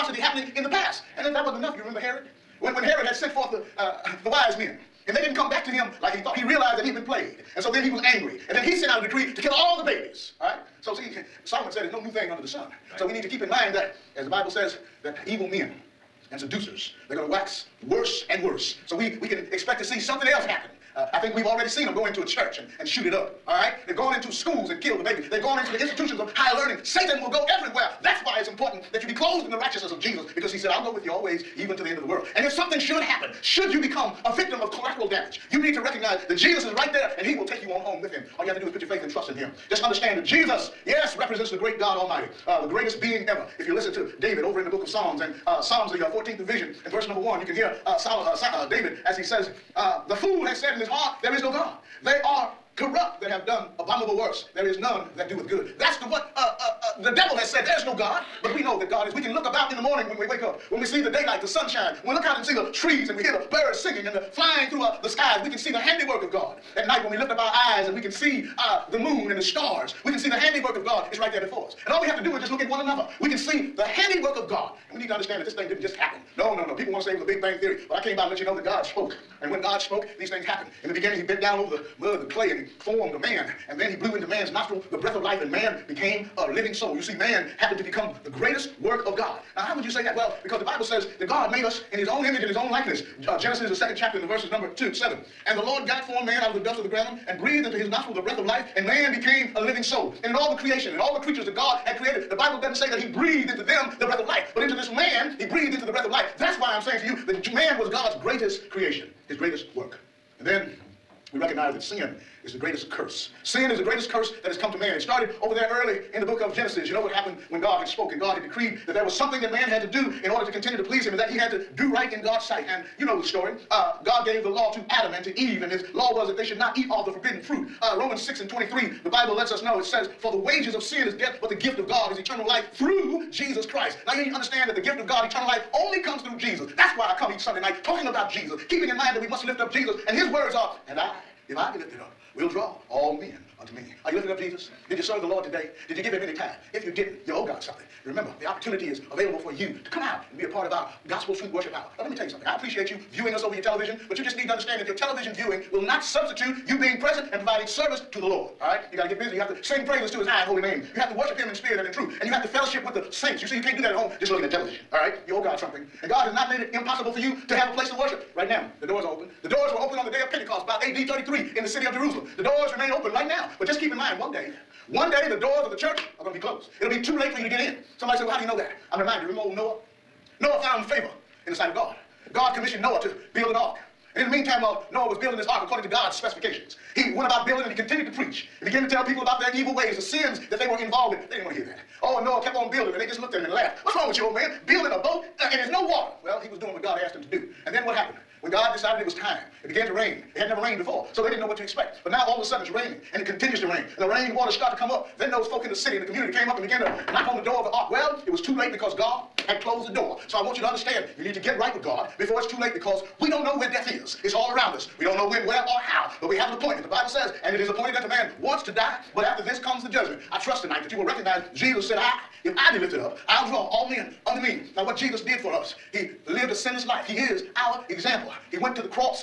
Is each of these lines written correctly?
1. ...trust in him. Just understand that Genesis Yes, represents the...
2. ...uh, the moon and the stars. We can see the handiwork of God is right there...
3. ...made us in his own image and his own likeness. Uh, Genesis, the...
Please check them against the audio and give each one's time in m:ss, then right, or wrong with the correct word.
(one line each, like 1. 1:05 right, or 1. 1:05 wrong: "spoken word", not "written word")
1. 0:39 wrong: "Jesus", not "Genesis"
2. 1:08 right
3. 1:31 right.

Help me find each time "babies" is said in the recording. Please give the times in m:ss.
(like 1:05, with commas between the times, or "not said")
0:09, 0:25.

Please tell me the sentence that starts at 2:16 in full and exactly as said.
That's why I come each Sunday night talking about Jesus, keeping in mind that we must lift up Jesus.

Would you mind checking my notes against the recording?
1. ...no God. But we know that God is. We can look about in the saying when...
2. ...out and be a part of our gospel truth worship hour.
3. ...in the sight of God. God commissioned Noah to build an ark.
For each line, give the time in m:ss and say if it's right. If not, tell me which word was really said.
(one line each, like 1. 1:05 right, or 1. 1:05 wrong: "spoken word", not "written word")
1. 0:57 wrong: "morning", not "saying"
2. 2:30 right
3. 3:01 right.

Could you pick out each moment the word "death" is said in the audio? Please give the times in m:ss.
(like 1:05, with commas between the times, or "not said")
2:11, 3:33.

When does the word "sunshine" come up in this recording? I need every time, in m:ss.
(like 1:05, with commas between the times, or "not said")
1:01.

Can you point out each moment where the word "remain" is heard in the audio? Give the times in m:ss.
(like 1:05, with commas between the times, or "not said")
2:52.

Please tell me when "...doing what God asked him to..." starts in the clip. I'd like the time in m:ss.
3:16.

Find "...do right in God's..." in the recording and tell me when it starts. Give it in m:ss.
2:01.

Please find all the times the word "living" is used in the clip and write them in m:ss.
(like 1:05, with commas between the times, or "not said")
1:26, 1:39.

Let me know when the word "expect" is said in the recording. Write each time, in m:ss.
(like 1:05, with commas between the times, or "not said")
0:19, 3:21.